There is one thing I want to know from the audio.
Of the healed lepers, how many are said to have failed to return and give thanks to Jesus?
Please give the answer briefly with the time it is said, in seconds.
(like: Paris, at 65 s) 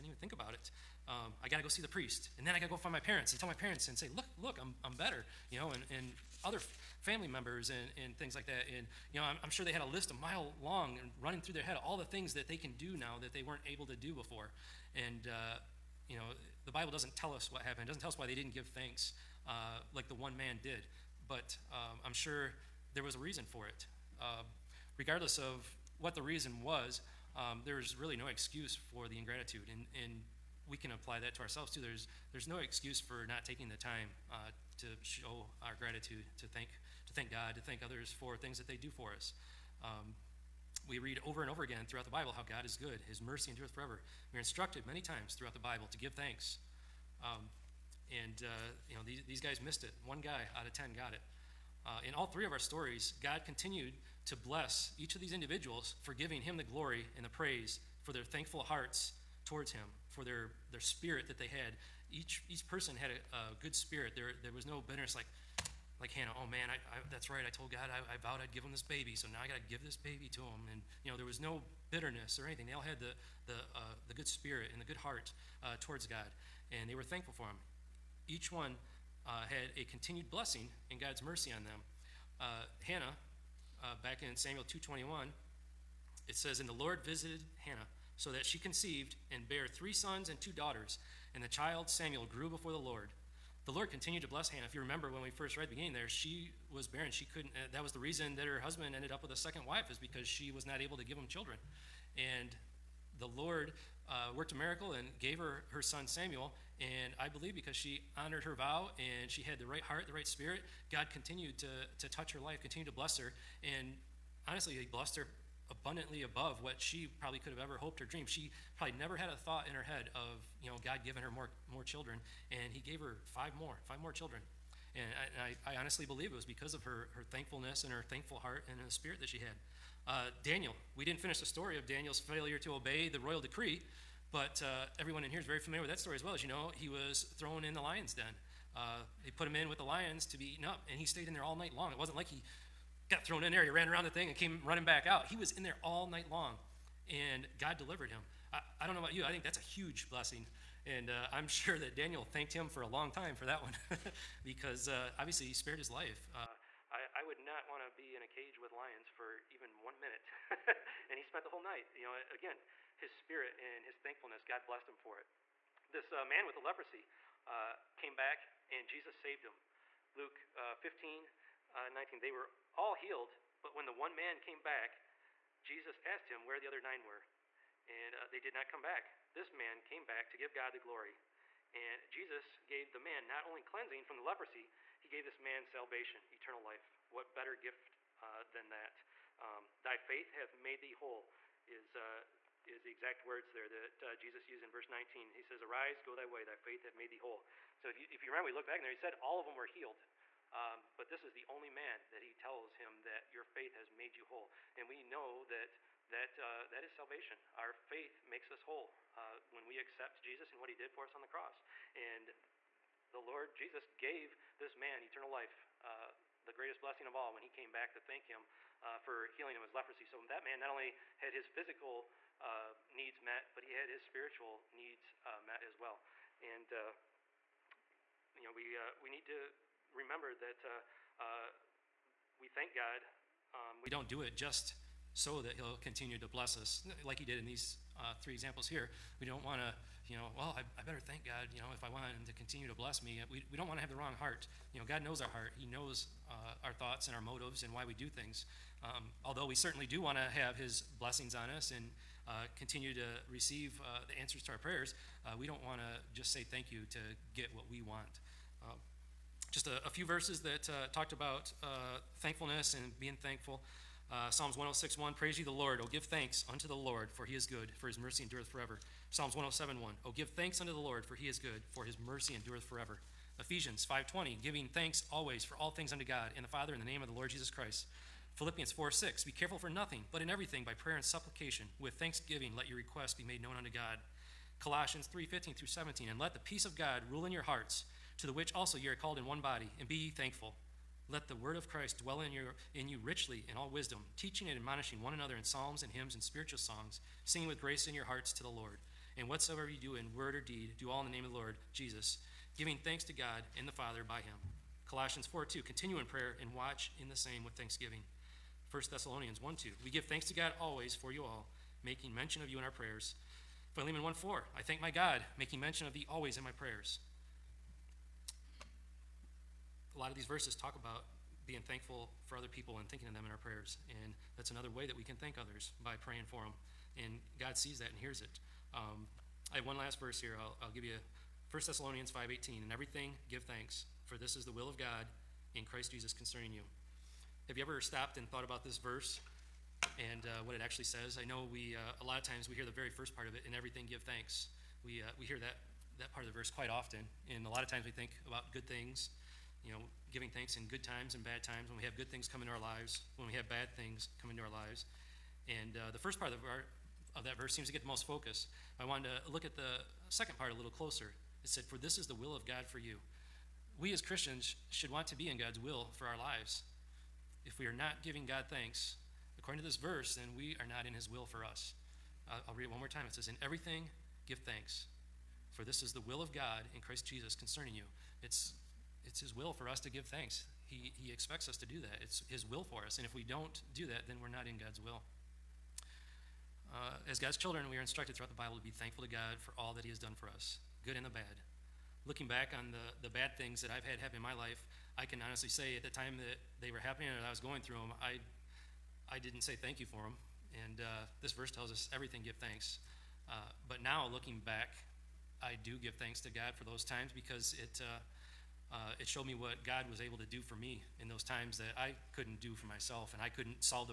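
9, at 176 s.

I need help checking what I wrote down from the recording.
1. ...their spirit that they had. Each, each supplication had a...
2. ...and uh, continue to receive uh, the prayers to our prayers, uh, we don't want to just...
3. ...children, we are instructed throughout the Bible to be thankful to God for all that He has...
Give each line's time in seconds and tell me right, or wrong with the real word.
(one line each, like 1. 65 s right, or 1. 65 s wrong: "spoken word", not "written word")
1. 60 s wrong: "person", not "supplication"
2. 251 s wrong: "answers", not "prayers"
3. 387 s right.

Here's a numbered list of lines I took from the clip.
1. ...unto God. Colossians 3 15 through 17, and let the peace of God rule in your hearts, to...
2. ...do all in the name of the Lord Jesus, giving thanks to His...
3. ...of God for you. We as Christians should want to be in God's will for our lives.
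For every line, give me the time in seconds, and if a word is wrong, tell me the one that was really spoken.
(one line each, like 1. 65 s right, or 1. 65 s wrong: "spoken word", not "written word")
1. 283 s right
2. 300 s wrong: "God", not "His"
3. 362 s right.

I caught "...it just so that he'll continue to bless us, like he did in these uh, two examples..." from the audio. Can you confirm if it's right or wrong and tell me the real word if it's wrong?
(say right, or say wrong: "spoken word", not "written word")
wrong: "three", not "two".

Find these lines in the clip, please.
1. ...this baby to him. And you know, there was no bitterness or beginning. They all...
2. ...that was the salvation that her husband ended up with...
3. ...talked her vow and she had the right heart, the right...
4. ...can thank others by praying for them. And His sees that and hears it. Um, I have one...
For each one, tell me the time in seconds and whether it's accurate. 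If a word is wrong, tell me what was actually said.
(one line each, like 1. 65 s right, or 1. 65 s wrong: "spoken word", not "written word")
1. 69 s wrong: "anything", not "beginning"
2. 97 s wrong: "reason", not "salvation"
3. 108 s wrong: "honored", not "talked"
4. 325 s wrong: "God", not "His".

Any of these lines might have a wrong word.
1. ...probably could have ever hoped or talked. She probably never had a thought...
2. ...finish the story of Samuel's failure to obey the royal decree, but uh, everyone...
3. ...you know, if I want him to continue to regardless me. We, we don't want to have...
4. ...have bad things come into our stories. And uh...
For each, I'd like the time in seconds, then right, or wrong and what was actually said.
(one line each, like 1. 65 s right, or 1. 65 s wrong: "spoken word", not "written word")
1. 117 s wrong: "dreamed", not "talked"
2. 131 s wrong: "Daniel", not "Samuel"
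3. 241 s wrong: "bless", not "regardless"
4. 353 s wrong: "lives", not "stories".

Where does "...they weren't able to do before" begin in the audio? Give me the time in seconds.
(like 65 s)
13 s.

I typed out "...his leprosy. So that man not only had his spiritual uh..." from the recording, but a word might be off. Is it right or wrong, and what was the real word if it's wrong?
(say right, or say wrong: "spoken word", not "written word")
wrong: "physical", not "spiritual".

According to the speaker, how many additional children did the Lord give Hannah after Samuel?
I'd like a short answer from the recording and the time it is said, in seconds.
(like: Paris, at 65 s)
5, at 123 s.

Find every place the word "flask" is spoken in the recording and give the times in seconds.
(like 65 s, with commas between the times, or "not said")
not said.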